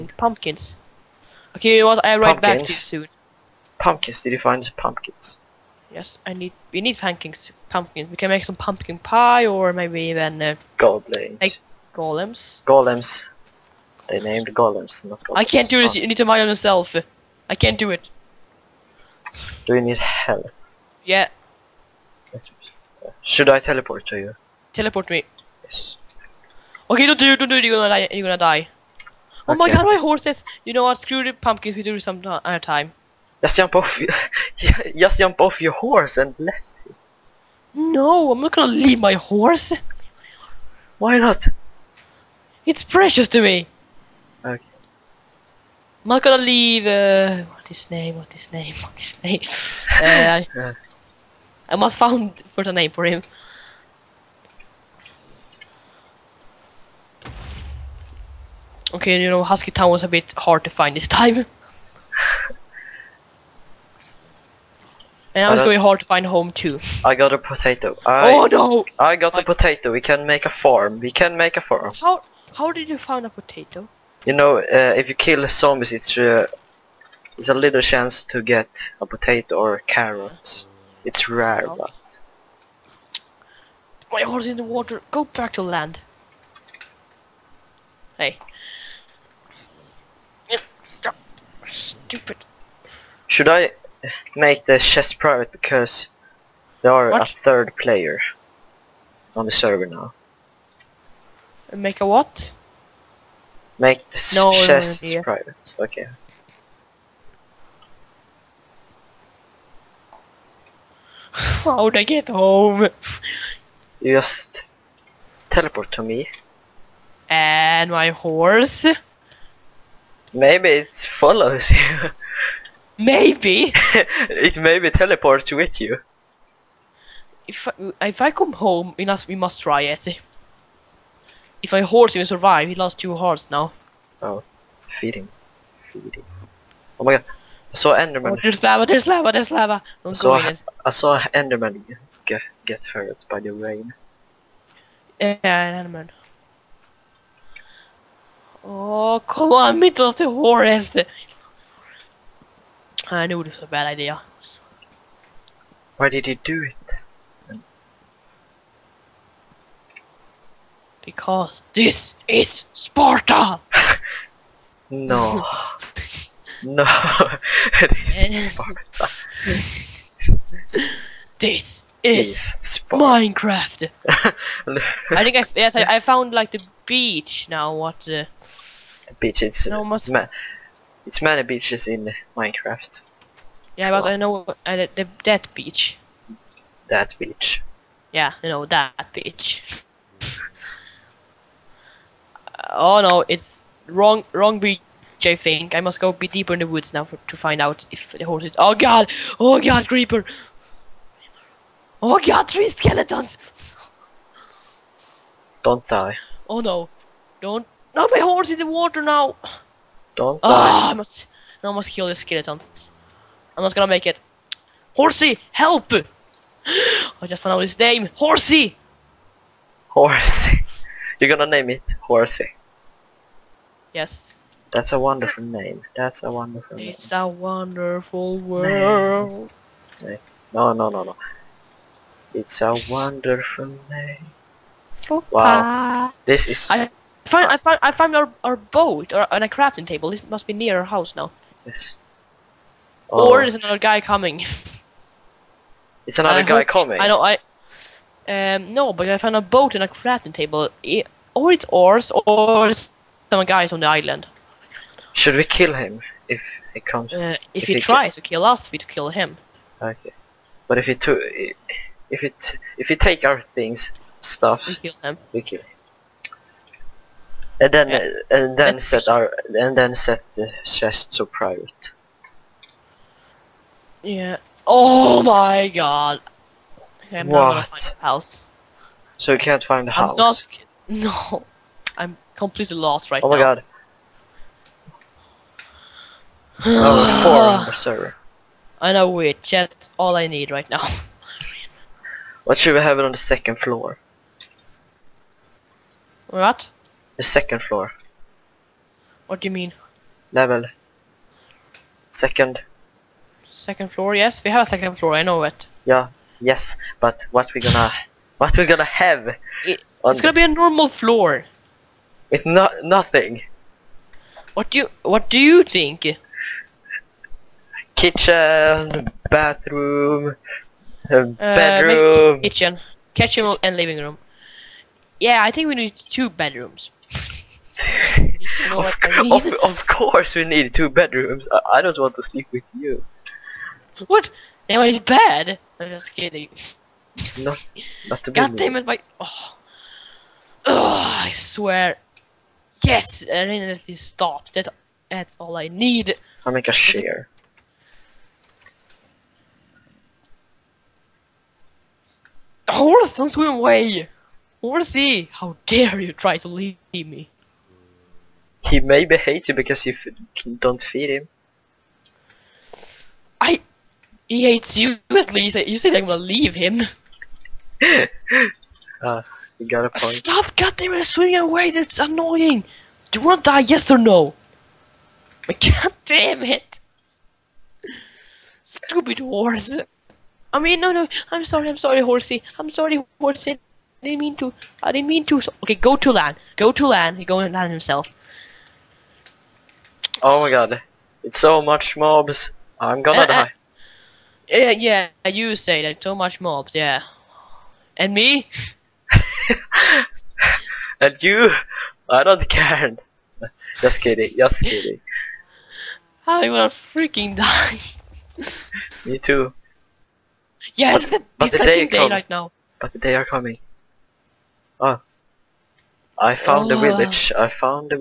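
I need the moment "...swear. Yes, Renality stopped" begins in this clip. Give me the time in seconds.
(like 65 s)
341 s.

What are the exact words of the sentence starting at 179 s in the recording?
It's no, must ma it's many beaches in Minecraft.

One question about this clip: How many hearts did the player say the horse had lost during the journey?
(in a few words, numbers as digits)
2.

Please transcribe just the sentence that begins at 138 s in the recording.
Oh, there's lava, there's lava, there's lava.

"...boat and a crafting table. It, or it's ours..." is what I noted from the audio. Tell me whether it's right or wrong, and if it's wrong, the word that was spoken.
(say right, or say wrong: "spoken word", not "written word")
right.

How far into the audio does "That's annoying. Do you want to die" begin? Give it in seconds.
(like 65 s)
371 s.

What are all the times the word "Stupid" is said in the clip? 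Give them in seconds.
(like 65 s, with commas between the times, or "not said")
91 s, 378 s.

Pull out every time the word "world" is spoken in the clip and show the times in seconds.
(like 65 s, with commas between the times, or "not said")
228 s.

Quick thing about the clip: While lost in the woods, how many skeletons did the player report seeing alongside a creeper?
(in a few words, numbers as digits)
3.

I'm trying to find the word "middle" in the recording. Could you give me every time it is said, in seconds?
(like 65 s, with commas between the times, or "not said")
149 s.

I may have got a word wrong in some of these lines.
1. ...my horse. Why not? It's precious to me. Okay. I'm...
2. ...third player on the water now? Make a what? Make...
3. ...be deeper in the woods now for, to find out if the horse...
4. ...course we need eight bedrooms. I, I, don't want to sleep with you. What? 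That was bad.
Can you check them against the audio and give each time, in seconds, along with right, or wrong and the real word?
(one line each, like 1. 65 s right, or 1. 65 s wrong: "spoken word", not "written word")
1. 38 s right
2. 97 s wrong: "server", not "water"
3. 196 s right
4. 329 s wrong: "two", not "eight".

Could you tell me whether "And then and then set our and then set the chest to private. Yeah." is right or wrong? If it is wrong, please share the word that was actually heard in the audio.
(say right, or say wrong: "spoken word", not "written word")
right.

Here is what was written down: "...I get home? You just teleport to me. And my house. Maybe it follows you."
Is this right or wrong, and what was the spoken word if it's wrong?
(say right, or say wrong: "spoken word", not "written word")
wrong: "horse", not "house".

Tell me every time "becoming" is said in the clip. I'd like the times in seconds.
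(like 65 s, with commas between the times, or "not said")
not said.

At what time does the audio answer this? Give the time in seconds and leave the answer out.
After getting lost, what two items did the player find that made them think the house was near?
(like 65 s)
238 s.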